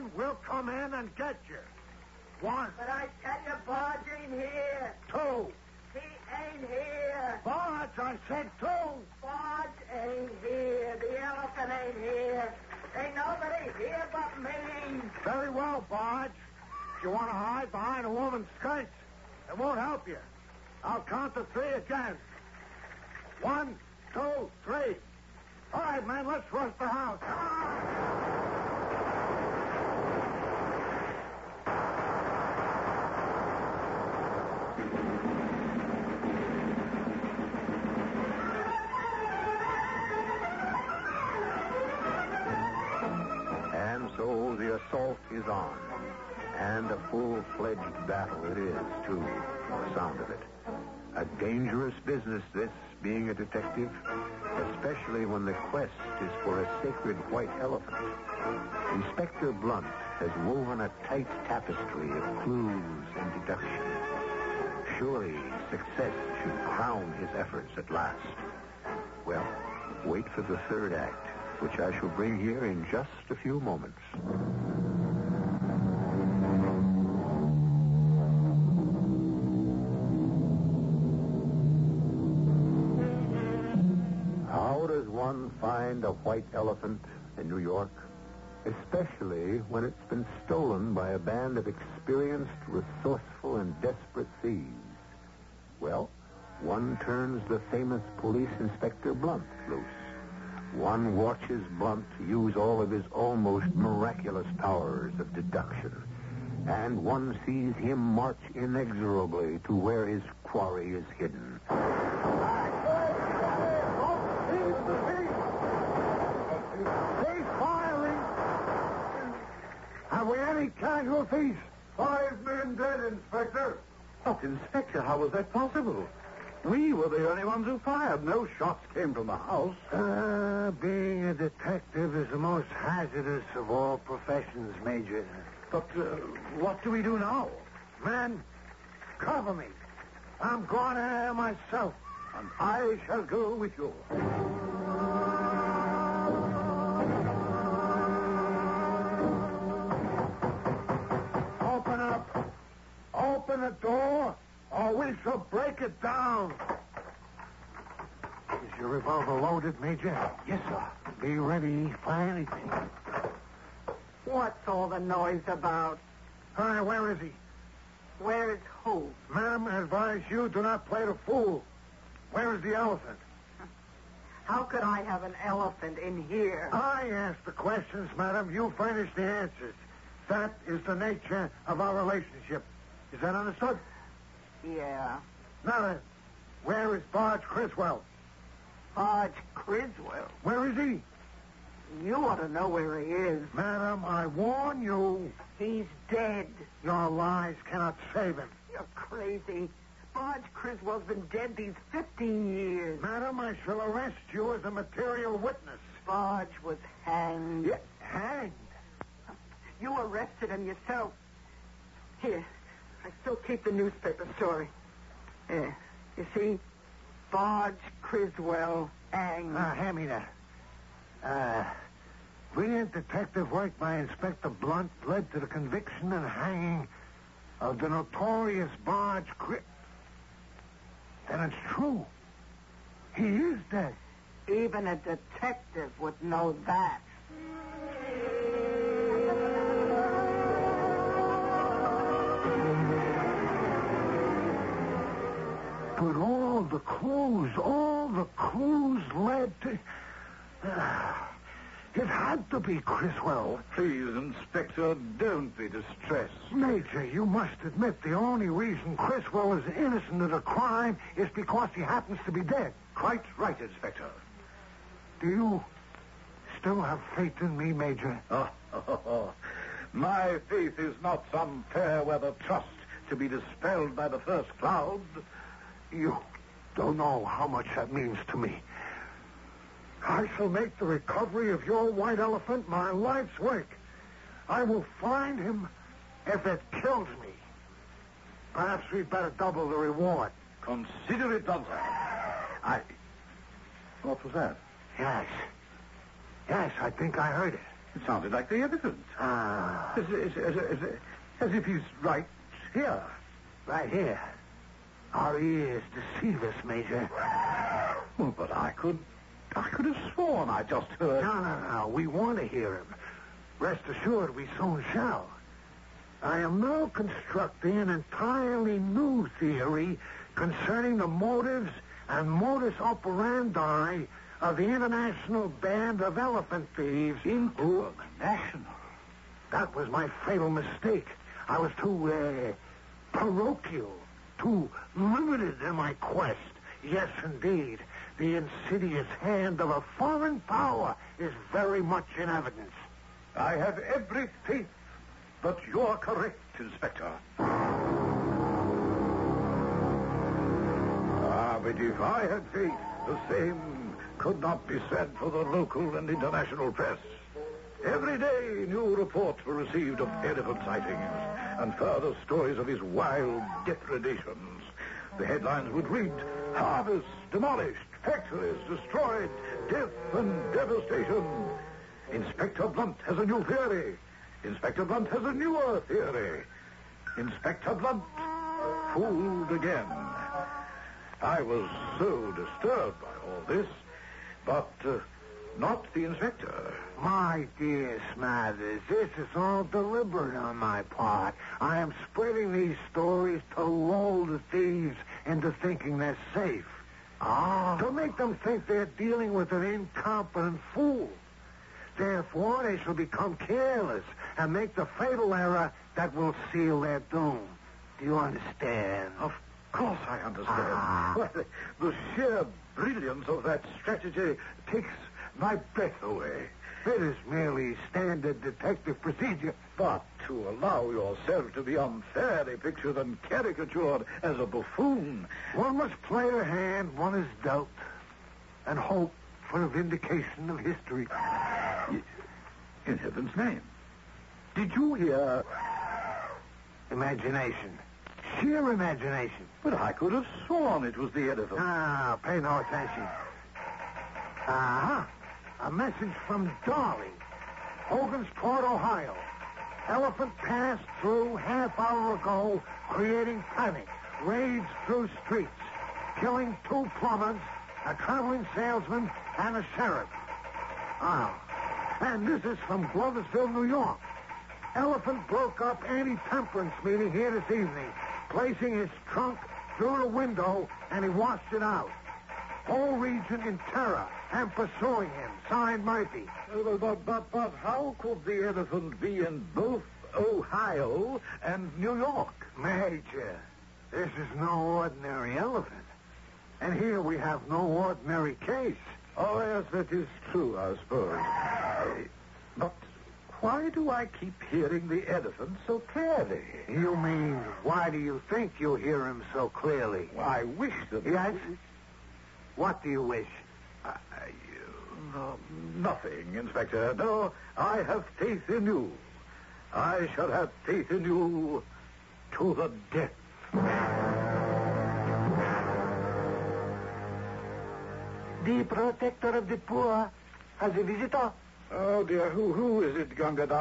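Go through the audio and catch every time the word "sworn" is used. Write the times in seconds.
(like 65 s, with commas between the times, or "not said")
310 s, 440 s.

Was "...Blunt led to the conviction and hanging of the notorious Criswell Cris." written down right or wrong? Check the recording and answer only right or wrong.
wrong.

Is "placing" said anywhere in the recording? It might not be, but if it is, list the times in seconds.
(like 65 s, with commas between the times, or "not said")
468 s.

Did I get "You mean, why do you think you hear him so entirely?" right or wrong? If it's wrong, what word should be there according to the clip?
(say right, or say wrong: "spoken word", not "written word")
wrong: "clearly", not "entirely".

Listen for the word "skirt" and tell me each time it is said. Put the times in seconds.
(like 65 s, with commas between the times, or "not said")
18 s.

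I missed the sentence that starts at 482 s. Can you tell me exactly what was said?
Major, this is no ordinary elephant.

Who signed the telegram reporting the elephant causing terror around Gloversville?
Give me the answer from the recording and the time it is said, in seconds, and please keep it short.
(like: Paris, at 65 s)
Murphy, at 475 s.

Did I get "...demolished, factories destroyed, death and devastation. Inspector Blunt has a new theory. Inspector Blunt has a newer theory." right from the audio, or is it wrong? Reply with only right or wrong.
right.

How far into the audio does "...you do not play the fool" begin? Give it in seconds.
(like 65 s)
170 s.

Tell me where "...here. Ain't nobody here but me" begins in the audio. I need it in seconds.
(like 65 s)
12 s.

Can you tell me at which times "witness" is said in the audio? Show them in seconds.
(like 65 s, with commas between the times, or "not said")
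205 s.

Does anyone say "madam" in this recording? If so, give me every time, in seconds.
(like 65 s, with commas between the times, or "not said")
178 s, 193 s, 203 s.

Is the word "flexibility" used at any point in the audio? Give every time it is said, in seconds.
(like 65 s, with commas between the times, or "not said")
not said.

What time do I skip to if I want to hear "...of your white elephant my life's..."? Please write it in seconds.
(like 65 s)
281 s.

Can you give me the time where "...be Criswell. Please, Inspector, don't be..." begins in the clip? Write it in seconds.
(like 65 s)
252 s.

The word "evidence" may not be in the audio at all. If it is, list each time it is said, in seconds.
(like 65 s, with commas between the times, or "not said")
298 s, 342 s.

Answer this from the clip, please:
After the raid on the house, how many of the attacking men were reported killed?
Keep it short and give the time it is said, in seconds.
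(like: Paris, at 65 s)
5, at 121 s.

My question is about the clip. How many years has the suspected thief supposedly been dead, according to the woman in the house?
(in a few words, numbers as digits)
15.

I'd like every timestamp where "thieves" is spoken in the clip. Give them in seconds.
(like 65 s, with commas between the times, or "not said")
94 s, 326 s, 394 s.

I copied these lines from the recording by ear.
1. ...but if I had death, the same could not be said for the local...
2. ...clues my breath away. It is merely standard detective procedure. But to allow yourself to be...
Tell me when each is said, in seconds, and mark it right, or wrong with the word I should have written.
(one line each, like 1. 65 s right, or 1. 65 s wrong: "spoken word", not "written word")
1. 351 s wrong: "faith", not "death"
2. 414 s wrong: "takes", not "clues".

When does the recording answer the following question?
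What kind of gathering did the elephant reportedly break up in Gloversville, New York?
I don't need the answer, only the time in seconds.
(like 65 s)
465 s.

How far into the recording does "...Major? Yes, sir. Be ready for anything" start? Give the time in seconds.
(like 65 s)
159 s.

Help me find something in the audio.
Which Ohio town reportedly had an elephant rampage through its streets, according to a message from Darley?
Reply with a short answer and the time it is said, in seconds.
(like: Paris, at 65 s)
Hogansport, at 447 s.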